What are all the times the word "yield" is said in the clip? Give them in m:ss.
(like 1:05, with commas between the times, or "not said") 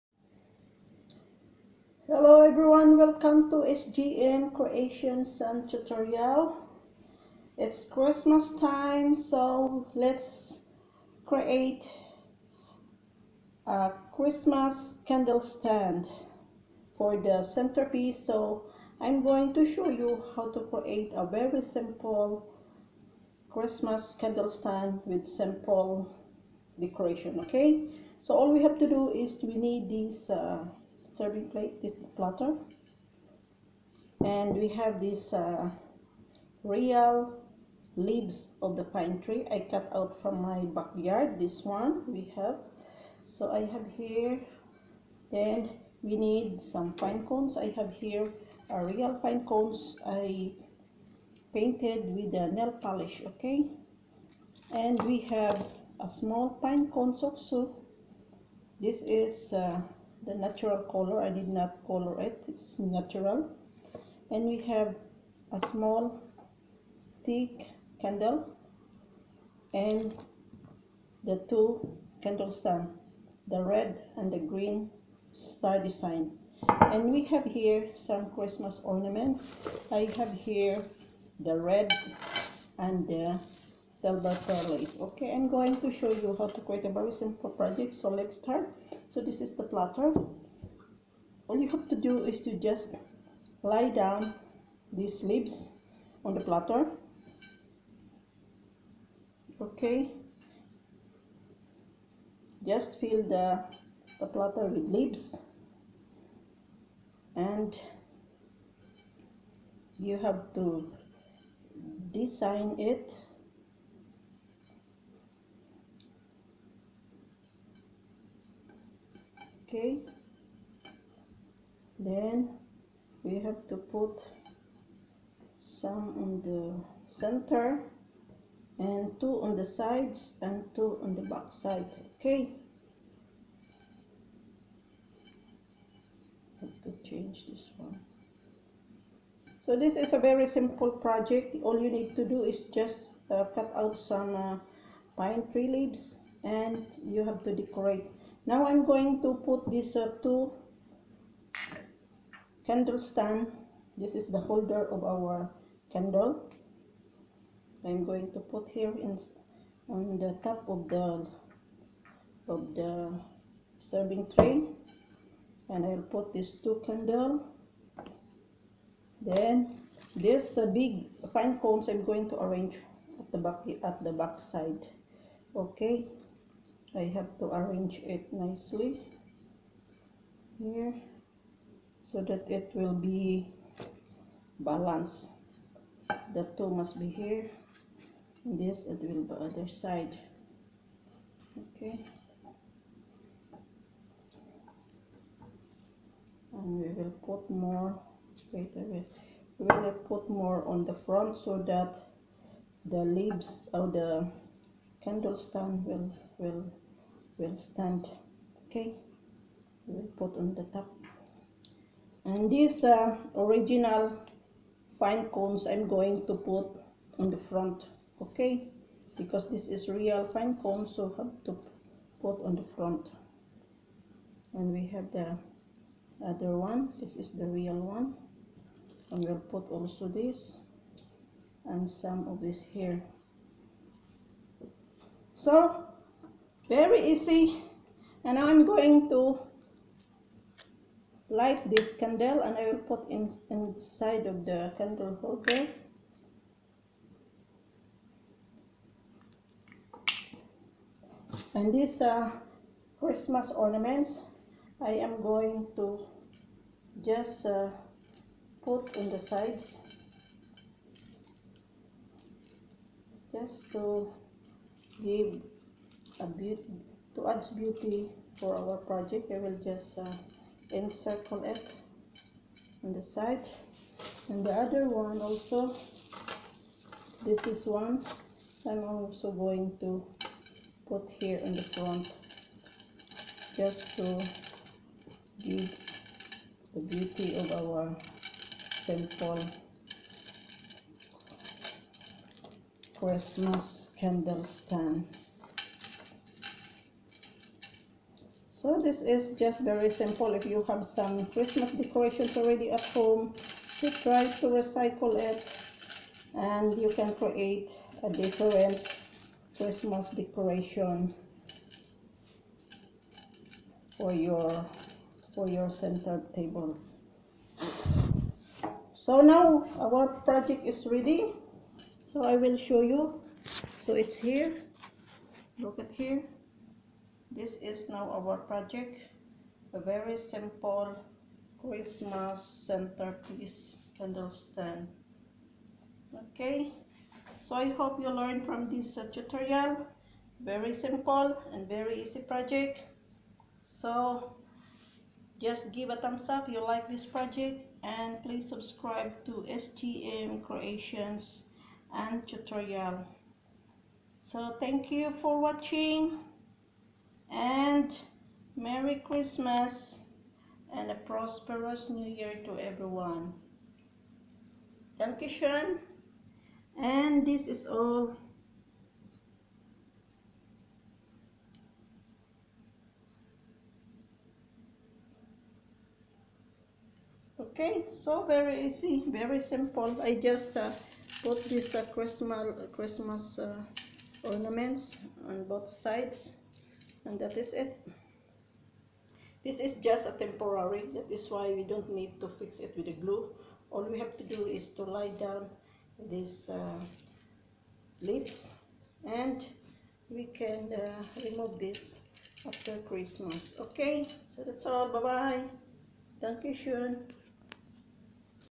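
not said.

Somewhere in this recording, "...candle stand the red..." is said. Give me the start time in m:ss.
1:12.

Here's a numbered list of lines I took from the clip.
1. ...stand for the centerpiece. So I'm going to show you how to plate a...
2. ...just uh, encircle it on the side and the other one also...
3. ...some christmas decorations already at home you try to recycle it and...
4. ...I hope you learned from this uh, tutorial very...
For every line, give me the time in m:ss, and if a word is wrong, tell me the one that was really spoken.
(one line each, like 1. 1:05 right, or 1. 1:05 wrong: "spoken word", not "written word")
1. 0:15 wrong: "create", not "plate"
2. 4:29 right
3. 5:00 right
4. 5:37 right.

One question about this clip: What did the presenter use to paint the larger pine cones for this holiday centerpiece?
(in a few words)
Nail polish.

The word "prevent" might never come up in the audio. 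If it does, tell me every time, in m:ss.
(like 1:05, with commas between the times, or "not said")
not said.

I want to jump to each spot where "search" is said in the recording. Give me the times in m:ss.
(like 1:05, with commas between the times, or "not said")
not said.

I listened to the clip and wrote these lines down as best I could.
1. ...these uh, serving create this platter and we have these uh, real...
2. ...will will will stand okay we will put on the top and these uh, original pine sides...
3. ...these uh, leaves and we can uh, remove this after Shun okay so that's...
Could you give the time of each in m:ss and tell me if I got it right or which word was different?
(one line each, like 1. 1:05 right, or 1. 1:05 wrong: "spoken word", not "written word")
1. 0:29 wrong: "plate", not "create"
2. 3:25 wrong: "cones", not "sides"
3. 6:36 wrong: "Christmas", not "Shun".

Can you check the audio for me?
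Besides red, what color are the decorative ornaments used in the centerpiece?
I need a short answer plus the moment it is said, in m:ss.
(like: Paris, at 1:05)
Silver, at 1:23.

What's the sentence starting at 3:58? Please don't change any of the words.
And now I'm going to light this candle and I will put in inside of the candle holder.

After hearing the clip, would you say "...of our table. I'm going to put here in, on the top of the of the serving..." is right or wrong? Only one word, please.
wrong.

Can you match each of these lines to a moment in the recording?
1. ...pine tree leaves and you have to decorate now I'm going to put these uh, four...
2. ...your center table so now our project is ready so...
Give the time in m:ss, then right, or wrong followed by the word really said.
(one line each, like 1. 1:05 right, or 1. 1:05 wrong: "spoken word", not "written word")
1. 2:25 wrong: "two", not "four"
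2. 5:15 right.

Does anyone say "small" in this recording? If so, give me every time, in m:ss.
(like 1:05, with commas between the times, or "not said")
0:56, 1:05.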